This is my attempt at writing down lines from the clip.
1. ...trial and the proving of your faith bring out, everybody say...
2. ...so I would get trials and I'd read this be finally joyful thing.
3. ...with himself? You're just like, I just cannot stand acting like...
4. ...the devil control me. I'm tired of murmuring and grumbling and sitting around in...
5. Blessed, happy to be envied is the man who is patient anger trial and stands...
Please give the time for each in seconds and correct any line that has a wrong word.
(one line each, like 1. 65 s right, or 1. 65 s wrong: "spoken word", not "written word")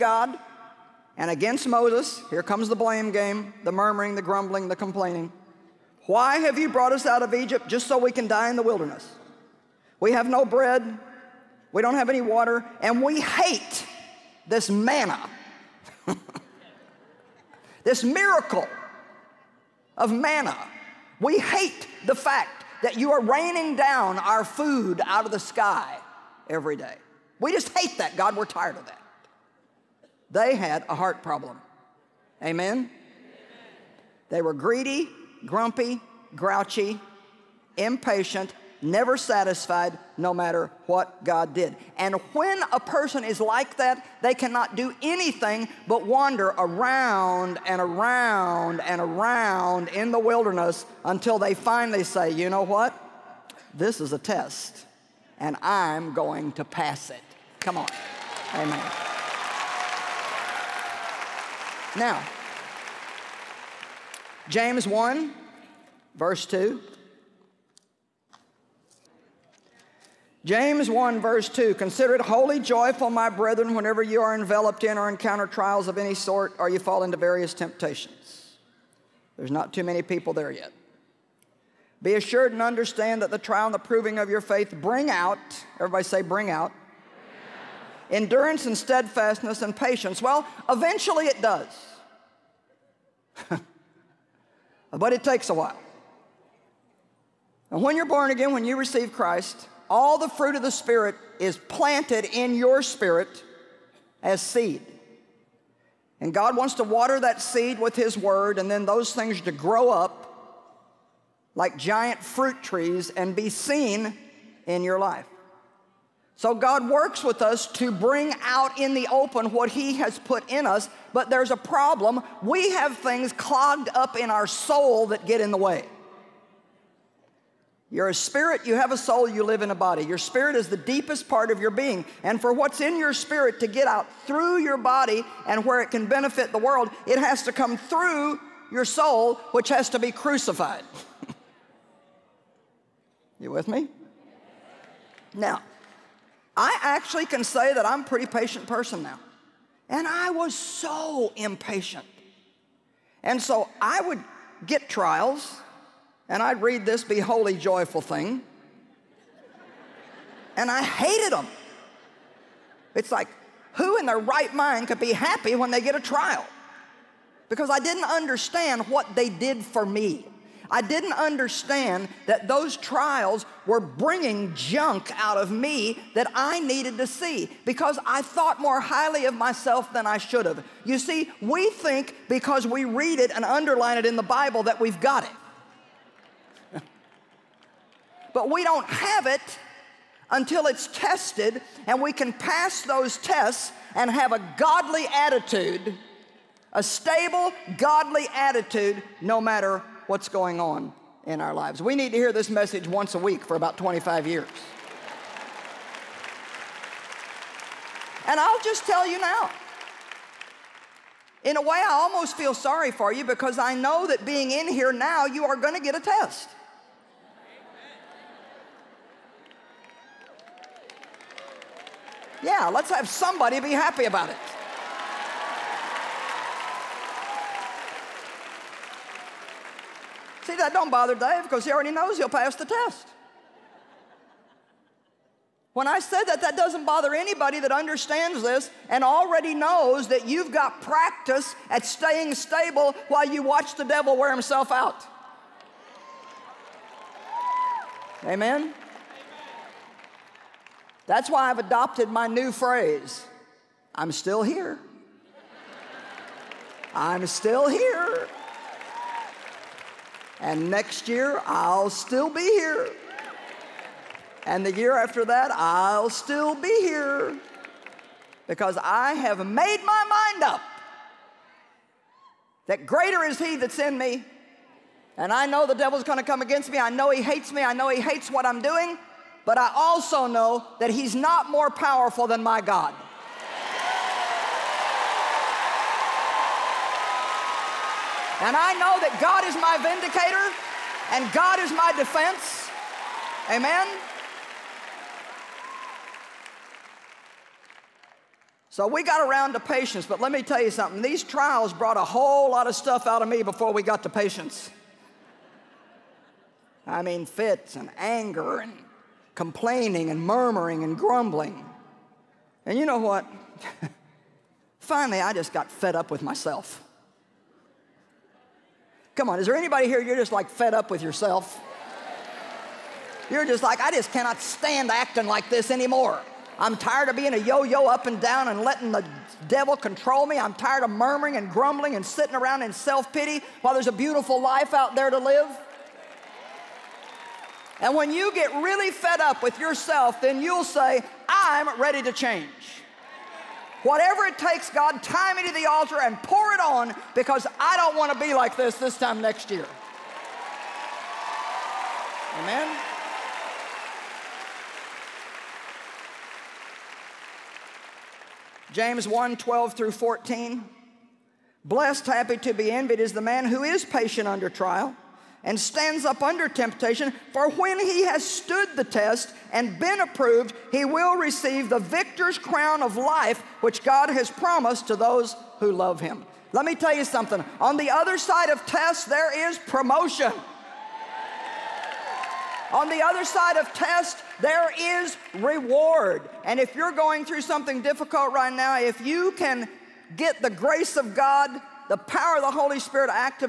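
1. 83 s right
2. 153 s wrong: "wholly", not "finally"
3. 320 s wrong: "yourself", not "himself"
4. 328 s right
5. 361 s wrong: "under", not "anger".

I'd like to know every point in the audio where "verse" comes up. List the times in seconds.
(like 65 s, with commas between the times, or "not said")
66 s, 71 s.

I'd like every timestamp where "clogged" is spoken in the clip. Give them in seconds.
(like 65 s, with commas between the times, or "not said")
123 s.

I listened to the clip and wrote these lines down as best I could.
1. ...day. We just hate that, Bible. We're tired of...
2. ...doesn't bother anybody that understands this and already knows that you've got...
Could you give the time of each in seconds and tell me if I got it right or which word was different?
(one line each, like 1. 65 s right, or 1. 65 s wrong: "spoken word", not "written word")
1. 26 s wrong: "God", not "Bible"
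2. 236 s right.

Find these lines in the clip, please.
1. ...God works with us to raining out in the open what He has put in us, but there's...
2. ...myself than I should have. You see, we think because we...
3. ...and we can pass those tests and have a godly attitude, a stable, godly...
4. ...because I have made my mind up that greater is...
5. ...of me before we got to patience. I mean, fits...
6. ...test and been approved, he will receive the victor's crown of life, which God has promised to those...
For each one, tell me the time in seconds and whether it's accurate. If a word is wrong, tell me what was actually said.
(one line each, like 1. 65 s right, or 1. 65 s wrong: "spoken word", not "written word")
1. 116 s wrong: "bring", not "raining"
2. 179 s right
3. 191 s right
4. 268 s right
5. 303 s right
6. 368 s right.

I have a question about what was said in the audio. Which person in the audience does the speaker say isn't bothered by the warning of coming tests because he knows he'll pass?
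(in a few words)
Dave.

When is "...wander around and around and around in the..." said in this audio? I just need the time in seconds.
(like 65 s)
46 s.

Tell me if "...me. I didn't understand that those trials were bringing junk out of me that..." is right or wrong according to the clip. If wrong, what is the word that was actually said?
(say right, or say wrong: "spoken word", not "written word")
right.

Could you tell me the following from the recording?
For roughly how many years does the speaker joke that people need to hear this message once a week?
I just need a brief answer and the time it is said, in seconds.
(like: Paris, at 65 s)
25, at 203 s.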